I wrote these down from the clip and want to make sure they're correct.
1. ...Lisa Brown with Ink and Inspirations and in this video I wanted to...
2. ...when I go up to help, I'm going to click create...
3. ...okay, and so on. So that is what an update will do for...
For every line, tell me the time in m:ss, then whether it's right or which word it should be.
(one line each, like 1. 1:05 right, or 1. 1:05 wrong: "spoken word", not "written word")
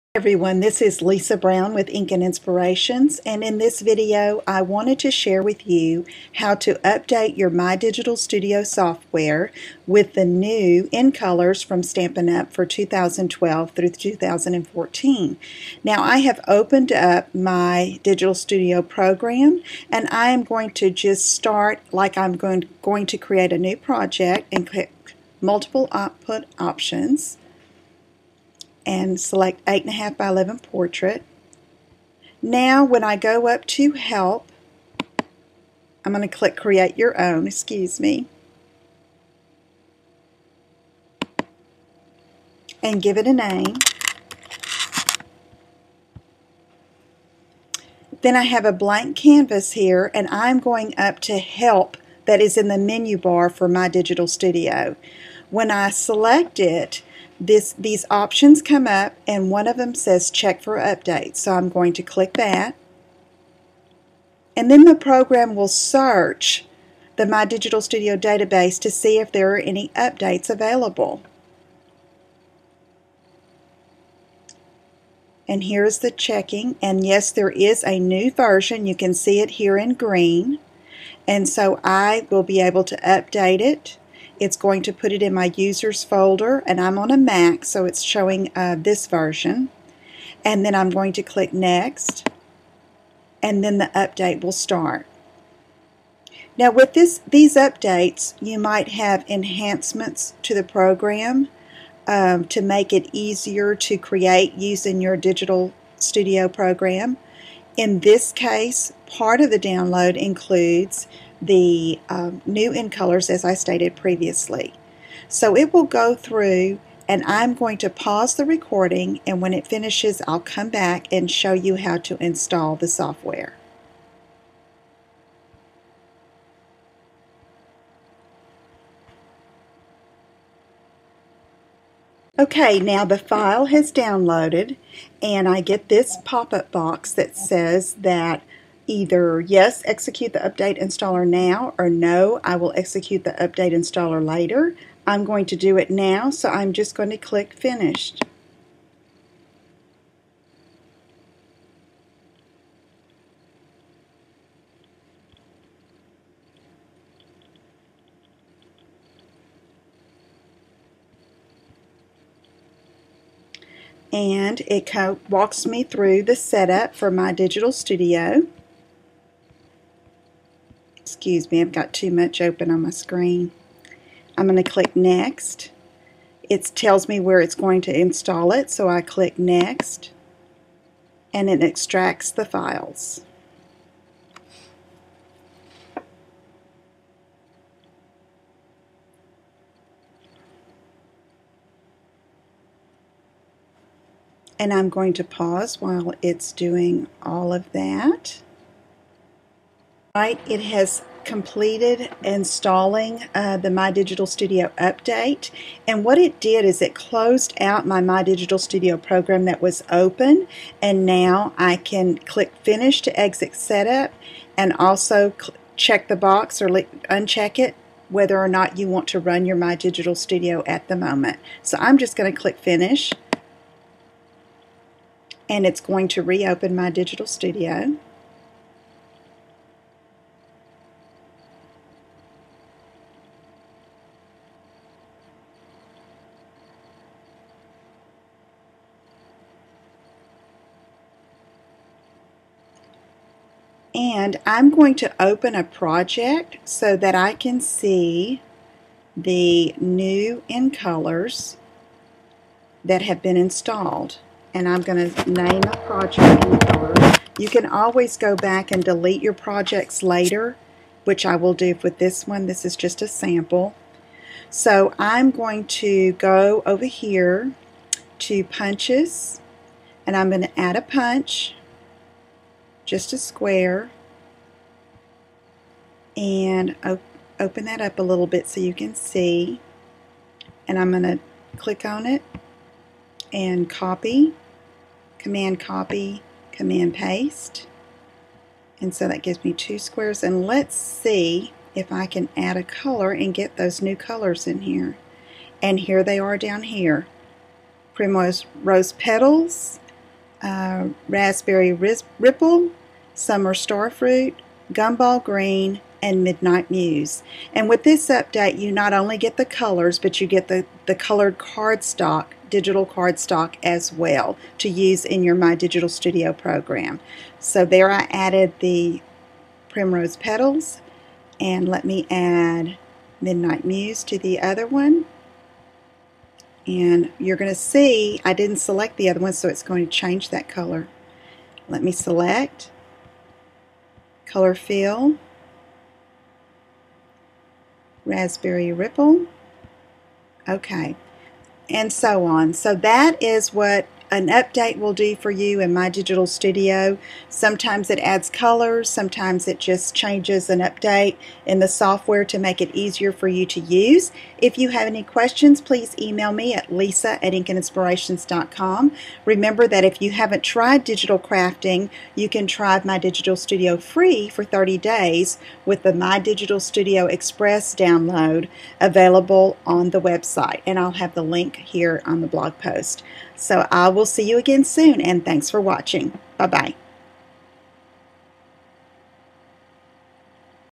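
1. 0:01 right
2. 0:32 right
3. 5:40 right.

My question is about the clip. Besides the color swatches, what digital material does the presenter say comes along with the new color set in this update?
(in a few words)
digital cardstock.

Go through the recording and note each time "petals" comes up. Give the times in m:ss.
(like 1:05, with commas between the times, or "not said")
4:58, 5:20.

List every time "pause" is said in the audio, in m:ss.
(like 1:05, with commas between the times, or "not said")
1:57, 3:15.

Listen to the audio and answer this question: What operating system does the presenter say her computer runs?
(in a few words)
Mac.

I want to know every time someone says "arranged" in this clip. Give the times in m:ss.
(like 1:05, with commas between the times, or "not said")
not said.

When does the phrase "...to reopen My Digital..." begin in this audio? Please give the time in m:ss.
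3:46.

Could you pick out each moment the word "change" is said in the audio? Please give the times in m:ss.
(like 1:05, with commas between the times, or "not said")
5:29, 5:49.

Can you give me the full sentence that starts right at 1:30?
And then I'm going to click next and then the update will start.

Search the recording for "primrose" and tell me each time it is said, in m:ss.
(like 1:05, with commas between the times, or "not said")
4:57, 5:19.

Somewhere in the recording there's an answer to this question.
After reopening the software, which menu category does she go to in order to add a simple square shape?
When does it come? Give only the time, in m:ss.
4:28.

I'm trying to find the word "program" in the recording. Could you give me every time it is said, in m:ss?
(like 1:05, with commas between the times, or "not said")
0:18, 1:04, 1:40, 1:46, 3:28, 5:16.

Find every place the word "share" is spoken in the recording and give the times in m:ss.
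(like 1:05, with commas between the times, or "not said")
0:05.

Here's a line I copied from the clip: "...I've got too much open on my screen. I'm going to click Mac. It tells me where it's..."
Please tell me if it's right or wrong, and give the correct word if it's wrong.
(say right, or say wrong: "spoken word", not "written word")
wrong: "Next", not "Mac".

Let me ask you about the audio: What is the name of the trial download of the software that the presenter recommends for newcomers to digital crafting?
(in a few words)
My Digital Studio Express.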